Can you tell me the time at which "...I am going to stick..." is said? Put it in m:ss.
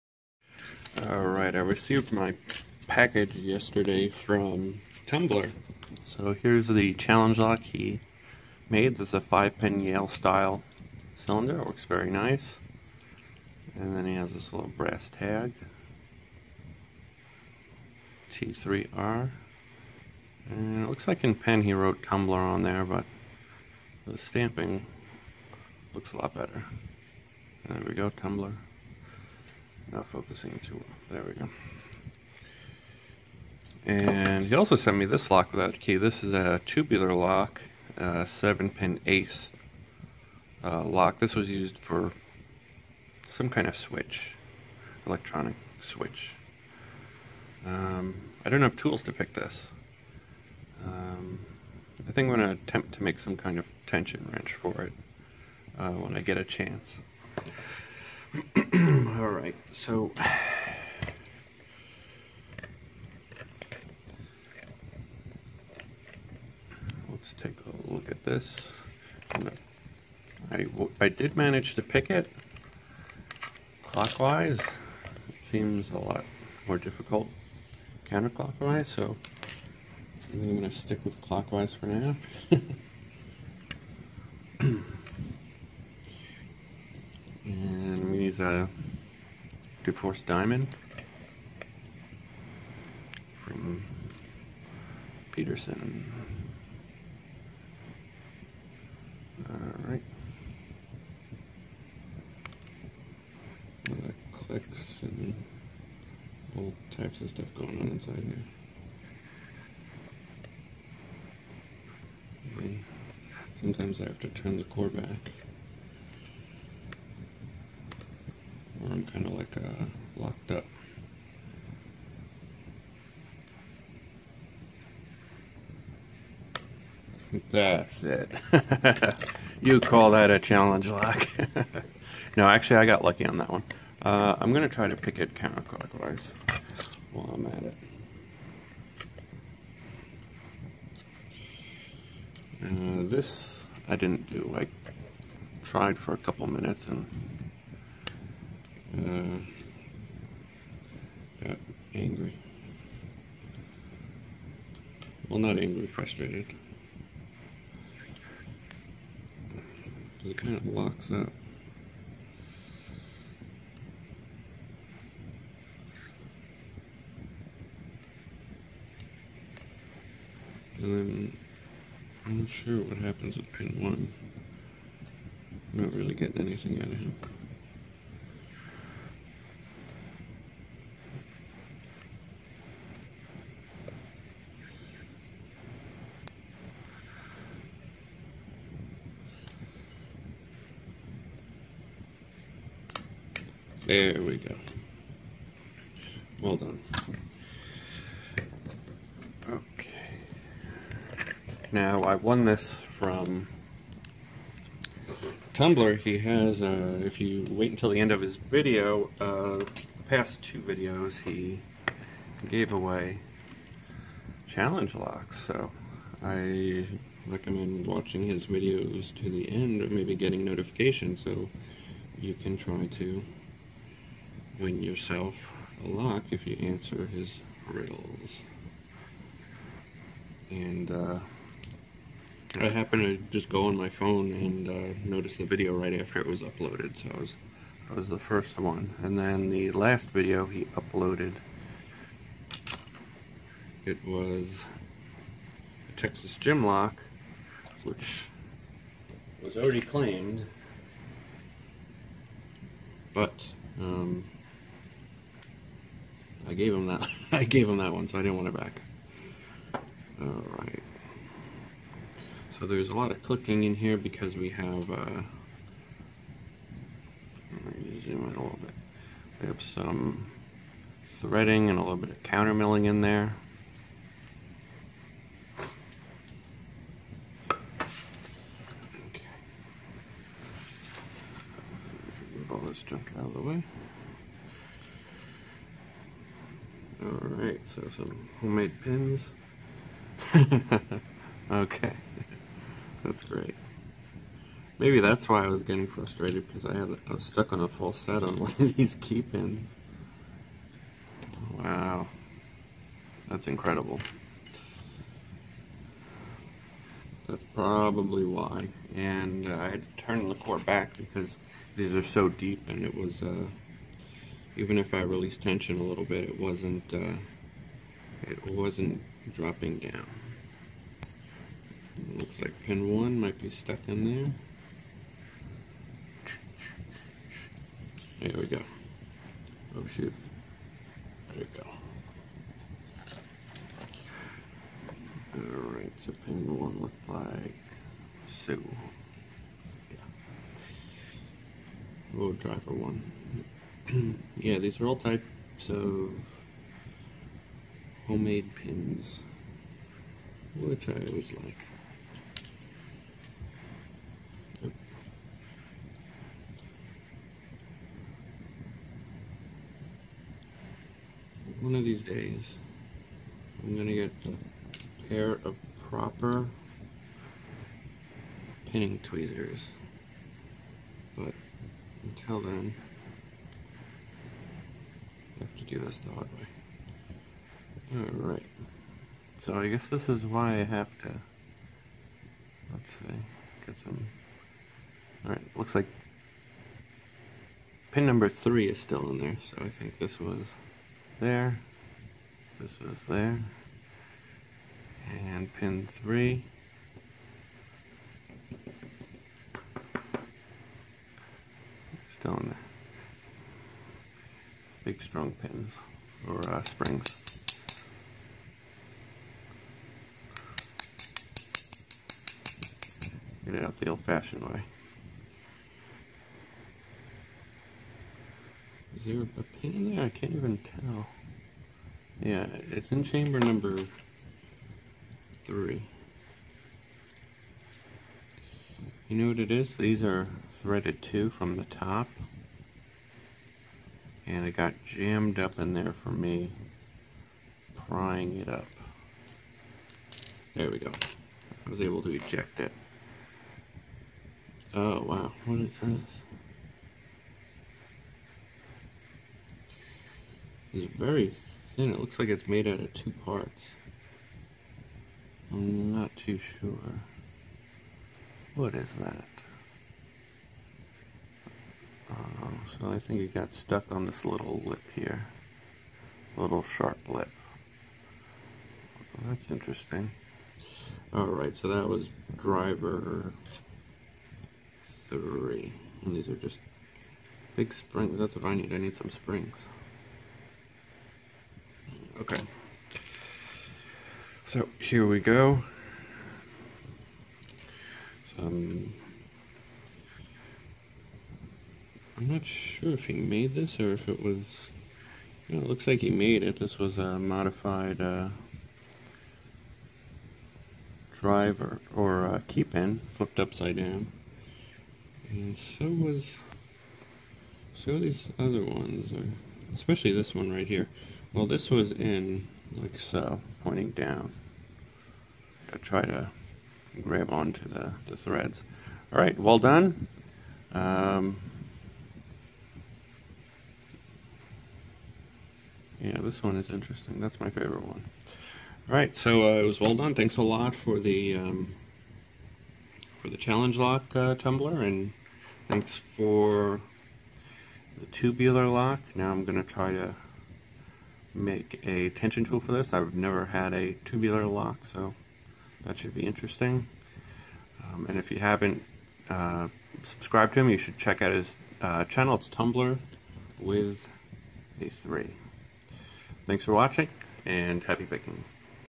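1:20.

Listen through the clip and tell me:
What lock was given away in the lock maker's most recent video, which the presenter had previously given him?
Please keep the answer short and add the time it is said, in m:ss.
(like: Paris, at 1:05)
Texas gym lock, at 4:05.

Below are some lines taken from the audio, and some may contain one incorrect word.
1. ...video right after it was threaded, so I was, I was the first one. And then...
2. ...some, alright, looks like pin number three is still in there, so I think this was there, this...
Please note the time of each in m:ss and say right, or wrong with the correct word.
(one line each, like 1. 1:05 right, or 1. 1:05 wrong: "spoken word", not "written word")
1. 3:55 wrong: "uploaded", not "threaded"
2. 6:23 right.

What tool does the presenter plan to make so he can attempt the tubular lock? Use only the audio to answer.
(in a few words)
tension tool.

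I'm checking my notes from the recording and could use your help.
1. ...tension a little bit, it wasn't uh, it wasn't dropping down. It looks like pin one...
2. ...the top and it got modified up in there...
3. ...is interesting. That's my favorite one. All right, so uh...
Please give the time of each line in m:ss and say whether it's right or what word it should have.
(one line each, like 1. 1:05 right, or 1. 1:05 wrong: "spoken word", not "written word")
1. 5:15 right
2. 7:11 wrong: "jammed", not "modified"
3. 8:46 right.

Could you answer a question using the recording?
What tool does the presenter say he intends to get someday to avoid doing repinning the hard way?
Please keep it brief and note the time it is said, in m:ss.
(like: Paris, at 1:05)
pinning tweezers, at 6:08.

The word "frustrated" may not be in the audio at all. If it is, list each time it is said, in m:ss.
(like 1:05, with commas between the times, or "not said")
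2:35, 4:55.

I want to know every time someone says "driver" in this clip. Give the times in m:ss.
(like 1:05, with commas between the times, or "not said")
5:42, 7:52, 8:21.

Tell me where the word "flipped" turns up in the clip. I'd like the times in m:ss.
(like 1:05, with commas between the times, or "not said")
8:23.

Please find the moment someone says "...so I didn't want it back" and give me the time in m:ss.
4:18.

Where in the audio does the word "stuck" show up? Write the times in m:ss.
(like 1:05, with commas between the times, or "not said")
4:57, 5:23, 7:43.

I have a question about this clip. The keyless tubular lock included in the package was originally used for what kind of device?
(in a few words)
electronic switch.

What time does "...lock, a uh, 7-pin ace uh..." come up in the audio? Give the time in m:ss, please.
0:37.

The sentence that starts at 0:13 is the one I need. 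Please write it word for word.
And then he has this little brass tag.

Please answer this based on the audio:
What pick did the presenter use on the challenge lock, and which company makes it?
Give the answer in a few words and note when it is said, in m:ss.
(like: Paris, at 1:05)
DeForest Diamond from Peterson, at 1:29.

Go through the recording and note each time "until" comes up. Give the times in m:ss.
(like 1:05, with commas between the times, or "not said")
3:27, 6:12.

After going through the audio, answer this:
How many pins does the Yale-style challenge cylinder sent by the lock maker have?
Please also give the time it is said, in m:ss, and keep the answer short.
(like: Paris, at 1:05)
5, at 0:09.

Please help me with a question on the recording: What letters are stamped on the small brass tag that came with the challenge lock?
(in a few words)
T3R.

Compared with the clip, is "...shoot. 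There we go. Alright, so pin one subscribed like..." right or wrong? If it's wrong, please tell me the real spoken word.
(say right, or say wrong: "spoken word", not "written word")
wrong: "looked", not "subscribed".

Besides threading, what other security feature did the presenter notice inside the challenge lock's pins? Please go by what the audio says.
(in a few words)
counter milling.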